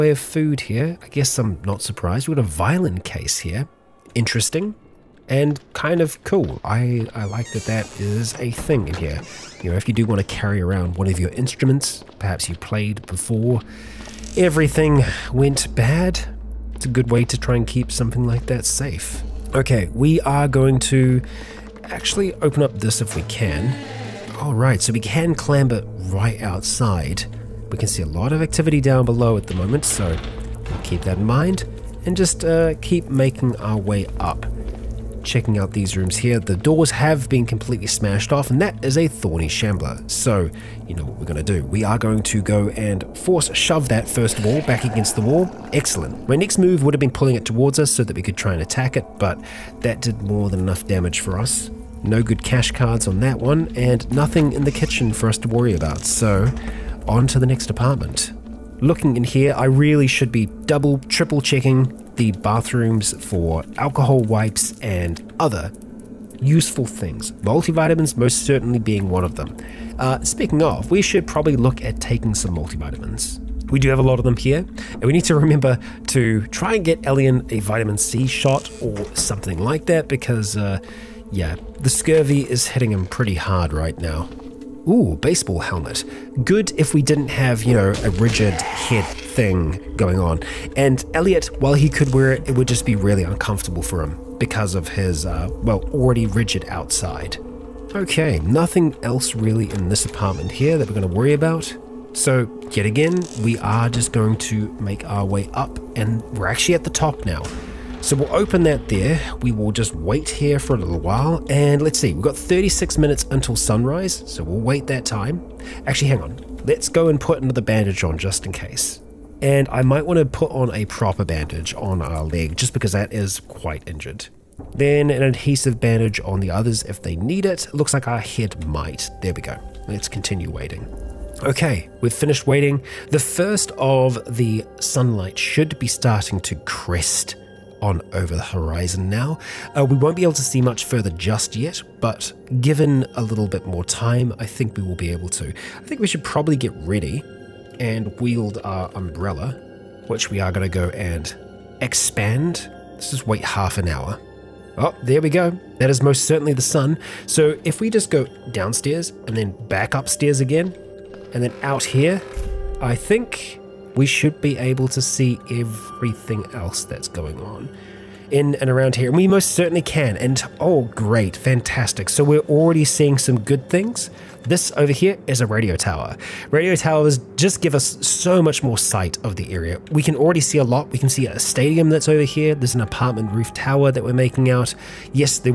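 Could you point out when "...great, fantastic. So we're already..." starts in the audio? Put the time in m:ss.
2:50.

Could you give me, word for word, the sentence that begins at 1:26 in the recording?
Good if we didn't have, you know, a rigid head thing going on.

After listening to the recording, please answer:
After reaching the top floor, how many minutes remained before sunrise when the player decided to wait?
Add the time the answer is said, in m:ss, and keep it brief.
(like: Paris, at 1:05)
36, at 1:52.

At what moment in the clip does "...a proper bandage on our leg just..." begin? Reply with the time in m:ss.
2:00.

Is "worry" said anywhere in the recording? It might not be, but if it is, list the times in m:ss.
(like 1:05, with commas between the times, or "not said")
0:55, 1:41.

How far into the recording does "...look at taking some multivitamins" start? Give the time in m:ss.
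1:11.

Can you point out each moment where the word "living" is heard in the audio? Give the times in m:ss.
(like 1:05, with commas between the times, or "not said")
not said.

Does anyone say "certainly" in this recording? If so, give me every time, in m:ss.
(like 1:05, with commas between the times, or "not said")
1:08, 2:36, 2:49.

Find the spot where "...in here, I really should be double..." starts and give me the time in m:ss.
0:59.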